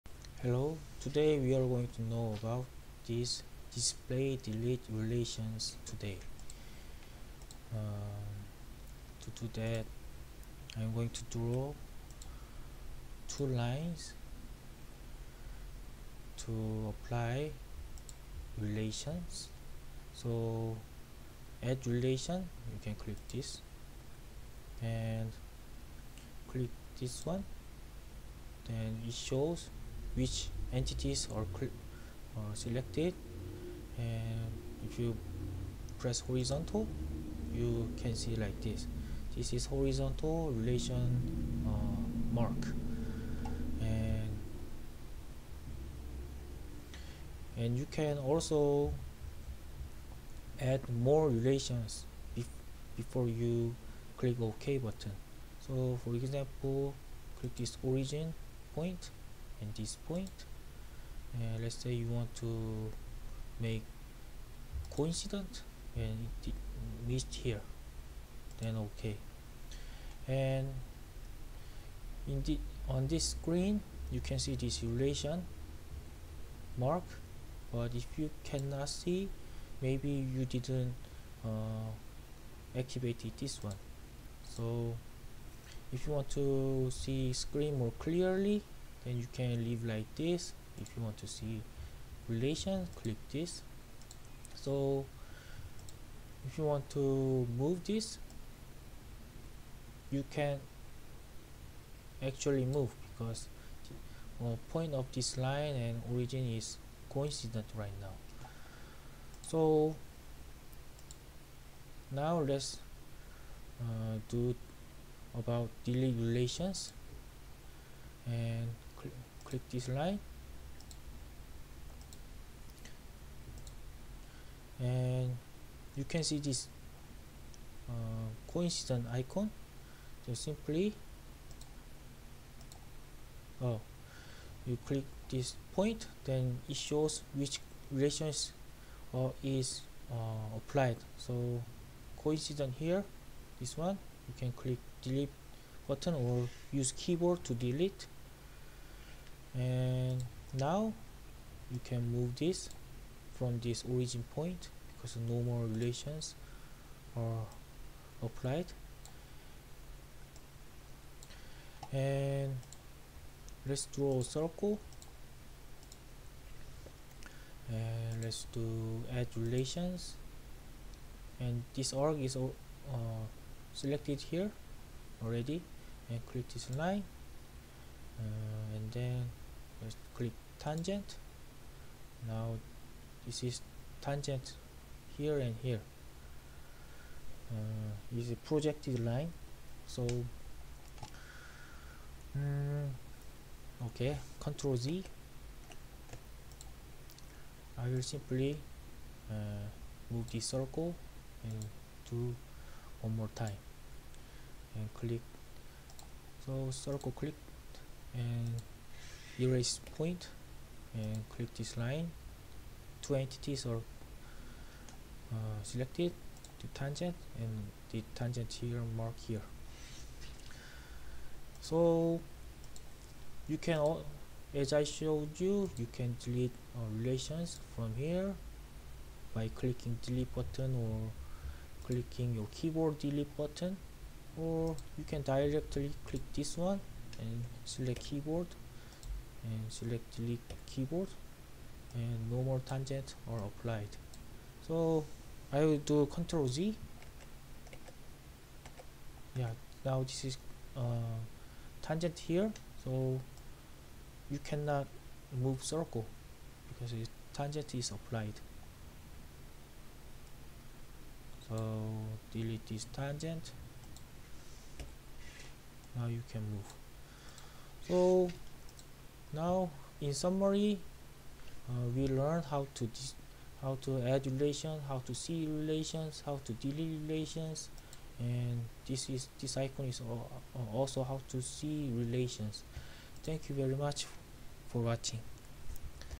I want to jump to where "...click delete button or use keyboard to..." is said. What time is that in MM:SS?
02:24.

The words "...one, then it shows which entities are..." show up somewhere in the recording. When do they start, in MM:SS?
00:27.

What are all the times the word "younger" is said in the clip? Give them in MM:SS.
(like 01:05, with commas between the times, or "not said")
not said.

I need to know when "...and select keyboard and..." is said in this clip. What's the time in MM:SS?
03:57.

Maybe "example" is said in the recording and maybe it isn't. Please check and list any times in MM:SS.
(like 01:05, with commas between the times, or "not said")
00:56.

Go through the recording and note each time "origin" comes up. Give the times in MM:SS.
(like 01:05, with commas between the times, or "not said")
00:57, 01:46, 02:33.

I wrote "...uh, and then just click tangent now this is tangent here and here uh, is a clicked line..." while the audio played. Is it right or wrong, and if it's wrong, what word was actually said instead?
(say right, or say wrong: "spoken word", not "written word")
wrong: "projected", not "clicked".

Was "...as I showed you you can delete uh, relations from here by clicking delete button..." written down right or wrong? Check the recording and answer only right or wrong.
right.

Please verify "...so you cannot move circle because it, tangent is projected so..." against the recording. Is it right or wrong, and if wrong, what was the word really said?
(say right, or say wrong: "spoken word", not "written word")
wrong: "applied", not "projected".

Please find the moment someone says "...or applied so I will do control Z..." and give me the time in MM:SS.
04:03.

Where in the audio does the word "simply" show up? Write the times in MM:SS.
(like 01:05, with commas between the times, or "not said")
02:10, 03:18.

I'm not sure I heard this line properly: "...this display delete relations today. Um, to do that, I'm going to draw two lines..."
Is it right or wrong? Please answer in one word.
right.